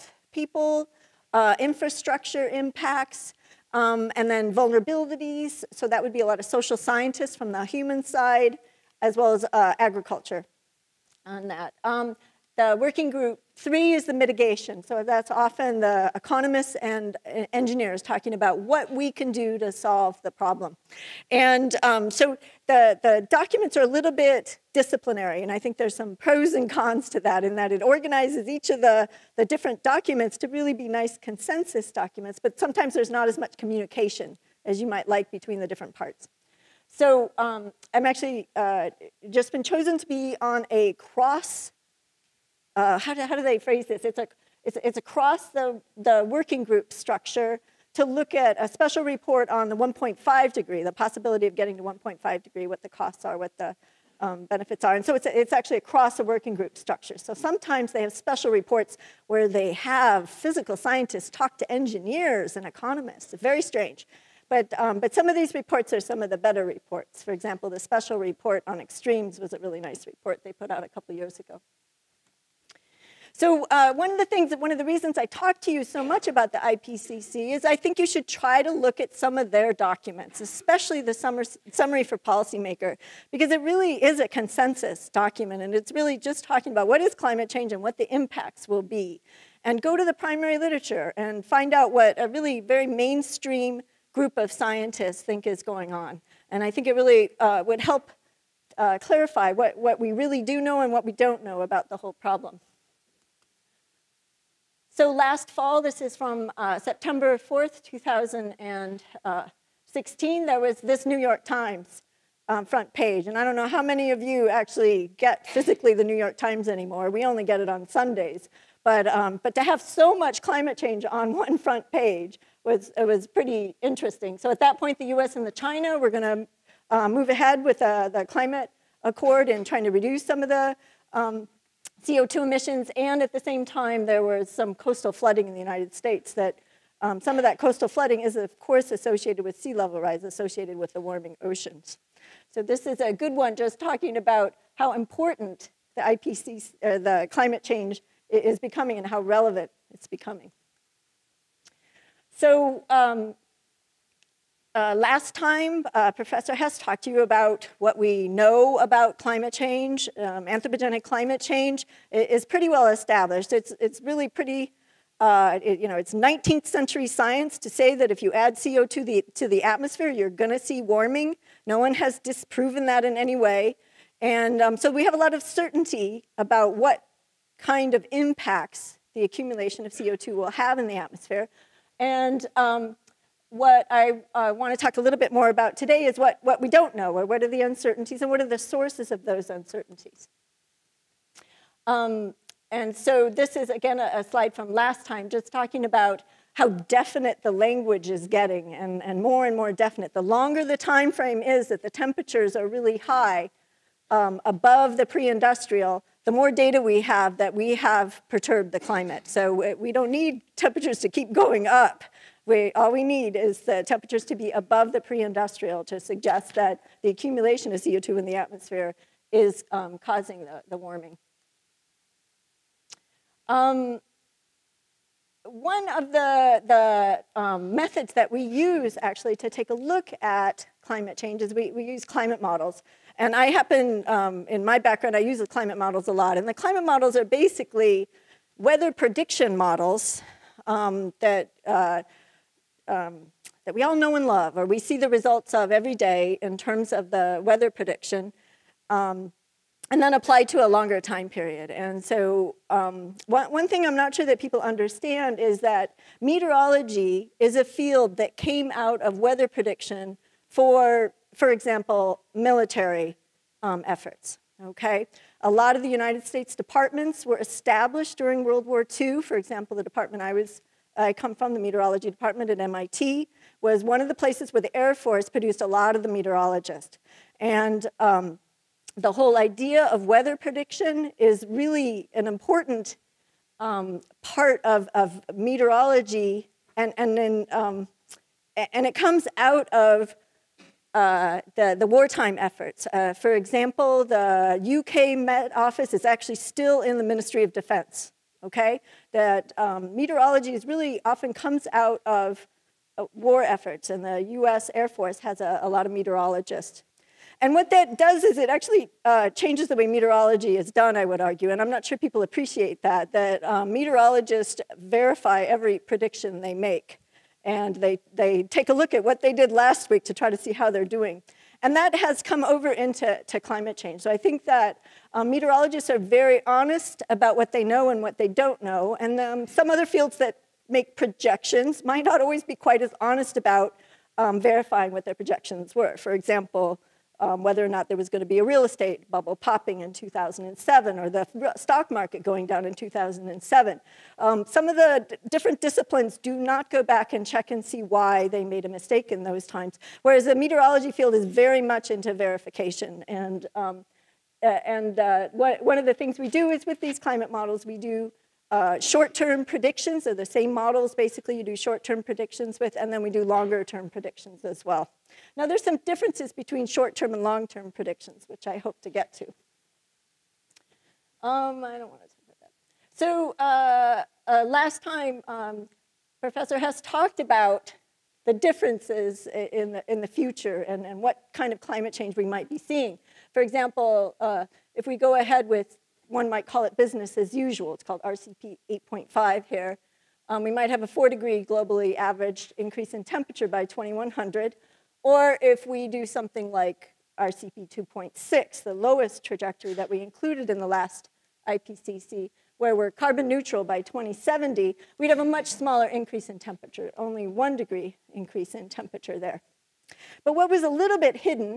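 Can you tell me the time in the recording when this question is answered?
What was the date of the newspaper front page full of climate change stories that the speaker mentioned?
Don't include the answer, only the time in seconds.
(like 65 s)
106 s.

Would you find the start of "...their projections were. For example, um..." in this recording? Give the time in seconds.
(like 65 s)
335 s.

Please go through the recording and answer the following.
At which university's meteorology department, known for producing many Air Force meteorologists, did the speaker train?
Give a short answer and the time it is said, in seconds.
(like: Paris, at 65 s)
MIT, at 272 s.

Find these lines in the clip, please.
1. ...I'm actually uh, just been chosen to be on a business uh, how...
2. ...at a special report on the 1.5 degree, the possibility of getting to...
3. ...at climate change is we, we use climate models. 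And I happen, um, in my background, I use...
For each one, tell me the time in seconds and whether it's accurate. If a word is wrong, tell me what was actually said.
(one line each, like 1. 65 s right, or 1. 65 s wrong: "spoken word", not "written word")
1. 37 s wrong: "cross", not "business"
2. 48 s right
3. 230 s right.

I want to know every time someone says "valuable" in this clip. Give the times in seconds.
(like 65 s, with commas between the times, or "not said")
not said.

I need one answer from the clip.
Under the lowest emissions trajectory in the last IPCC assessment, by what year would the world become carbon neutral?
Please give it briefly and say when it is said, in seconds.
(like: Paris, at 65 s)
2070, at 403 s.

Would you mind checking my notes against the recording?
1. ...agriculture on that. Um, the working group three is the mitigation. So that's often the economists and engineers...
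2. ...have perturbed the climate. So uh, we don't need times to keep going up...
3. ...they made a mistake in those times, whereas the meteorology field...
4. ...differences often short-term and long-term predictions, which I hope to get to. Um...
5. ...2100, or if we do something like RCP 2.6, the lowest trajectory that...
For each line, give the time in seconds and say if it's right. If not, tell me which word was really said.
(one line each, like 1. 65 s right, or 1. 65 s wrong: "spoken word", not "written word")
1. 9 s right
2. 207 s wrong: "temperatures", not "times"
3. 348 s right
4. 365 s wrong: "between", not "often"
5. 393 s right.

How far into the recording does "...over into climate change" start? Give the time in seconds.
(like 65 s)
322 s.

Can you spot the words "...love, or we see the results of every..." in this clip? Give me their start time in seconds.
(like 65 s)
244 s.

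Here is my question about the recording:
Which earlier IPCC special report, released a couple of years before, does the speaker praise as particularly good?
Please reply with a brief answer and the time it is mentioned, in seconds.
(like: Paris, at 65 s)
special report on extremes, at 67 s.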